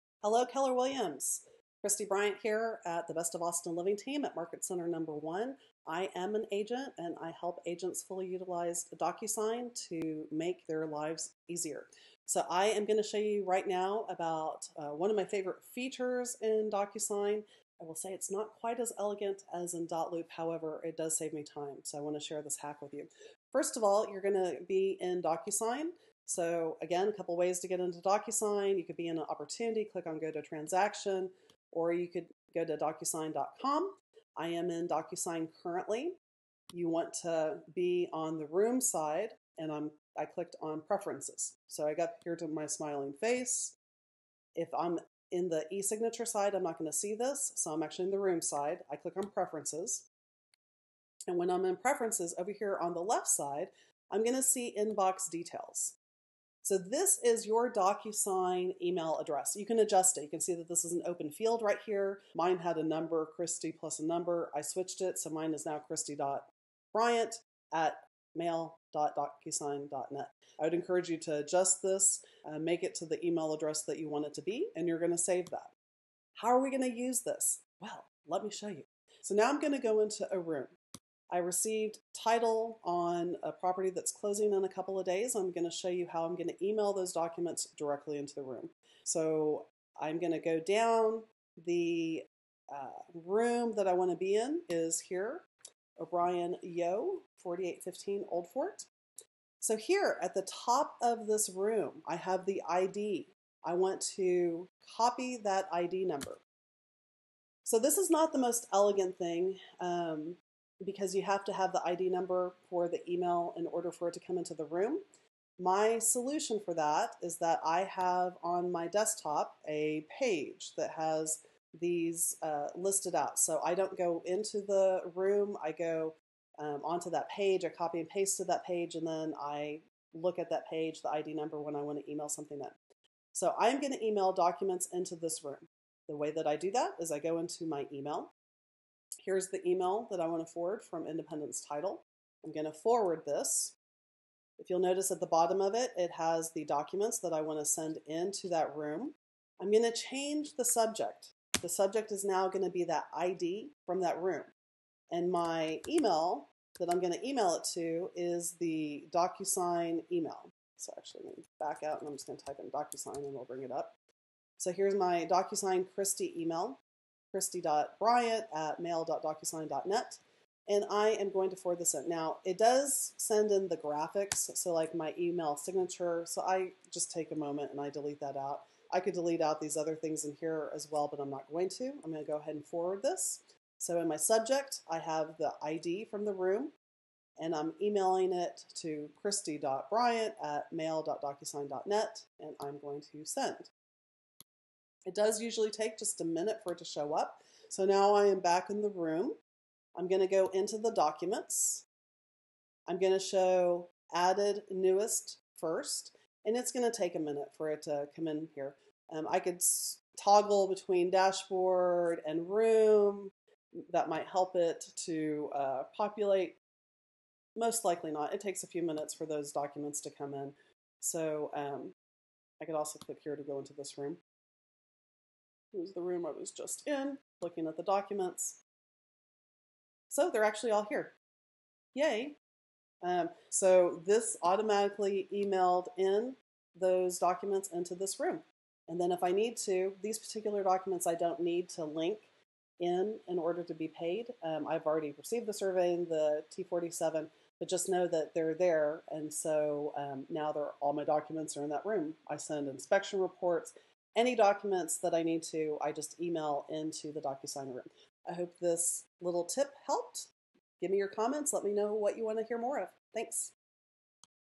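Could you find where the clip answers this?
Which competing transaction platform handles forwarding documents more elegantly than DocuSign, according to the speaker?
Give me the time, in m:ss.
0:19.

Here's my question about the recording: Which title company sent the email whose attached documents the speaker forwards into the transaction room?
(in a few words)
Independence Title.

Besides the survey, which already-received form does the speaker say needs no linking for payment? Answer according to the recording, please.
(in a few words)
T47.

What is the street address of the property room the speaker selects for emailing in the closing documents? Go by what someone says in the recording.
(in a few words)
4815 Old Fort.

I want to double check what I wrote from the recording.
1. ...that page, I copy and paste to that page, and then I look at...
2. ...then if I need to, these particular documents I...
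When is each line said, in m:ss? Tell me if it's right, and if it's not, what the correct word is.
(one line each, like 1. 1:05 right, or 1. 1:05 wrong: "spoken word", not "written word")
1. 2:07 right
2. 3:58 right.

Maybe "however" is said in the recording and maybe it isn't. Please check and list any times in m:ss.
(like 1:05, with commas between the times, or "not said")
0:20.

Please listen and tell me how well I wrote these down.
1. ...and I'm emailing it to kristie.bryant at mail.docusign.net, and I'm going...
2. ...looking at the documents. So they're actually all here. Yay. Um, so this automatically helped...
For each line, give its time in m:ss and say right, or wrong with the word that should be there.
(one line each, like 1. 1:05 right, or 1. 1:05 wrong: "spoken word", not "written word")
1. 3:07 right
2. 3:47 wrong: "emailed", not "helped".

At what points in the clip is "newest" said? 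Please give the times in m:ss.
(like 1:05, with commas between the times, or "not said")
3:24.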